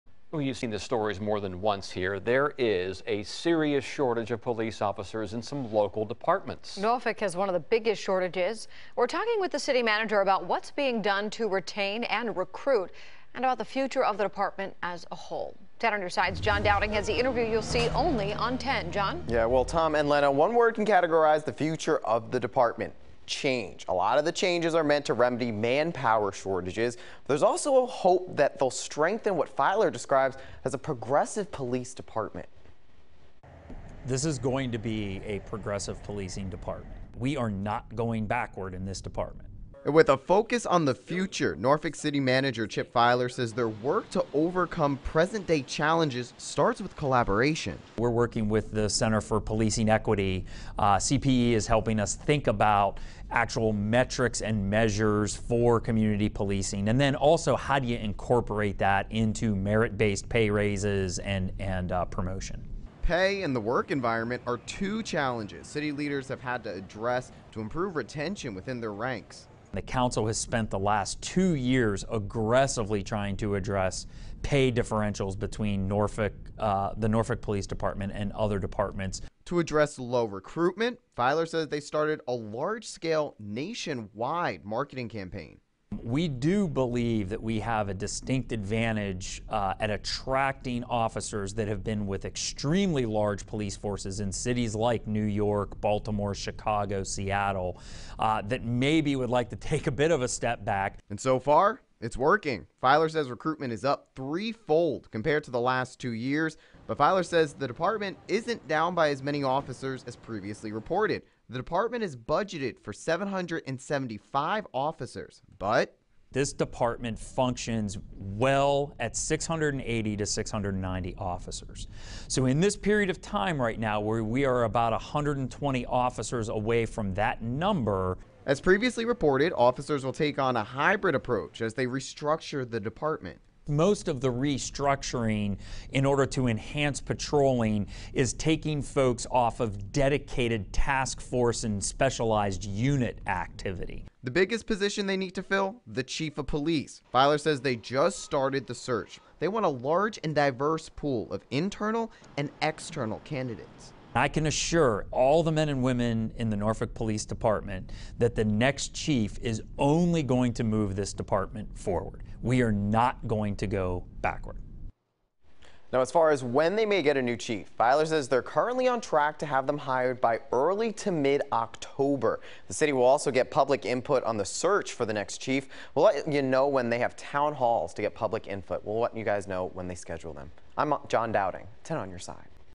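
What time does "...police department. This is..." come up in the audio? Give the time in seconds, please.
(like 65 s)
31 s.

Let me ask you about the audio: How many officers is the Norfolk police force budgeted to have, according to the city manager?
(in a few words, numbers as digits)
775.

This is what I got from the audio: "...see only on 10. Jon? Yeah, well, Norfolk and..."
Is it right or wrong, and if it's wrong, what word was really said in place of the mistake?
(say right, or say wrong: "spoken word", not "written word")
wrong: "Tom", not "Norfolk".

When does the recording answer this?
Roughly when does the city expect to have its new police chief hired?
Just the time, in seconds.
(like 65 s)
170 s.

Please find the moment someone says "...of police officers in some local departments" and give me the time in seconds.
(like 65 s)
4 s.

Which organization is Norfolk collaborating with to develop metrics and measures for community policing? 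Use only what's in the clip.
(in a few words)
Center for Policing Equity.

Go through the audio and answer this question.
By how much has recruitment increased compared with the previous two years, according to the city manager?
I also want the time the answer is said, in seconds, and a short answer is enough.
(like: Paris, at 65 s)
threefold, at 104 s.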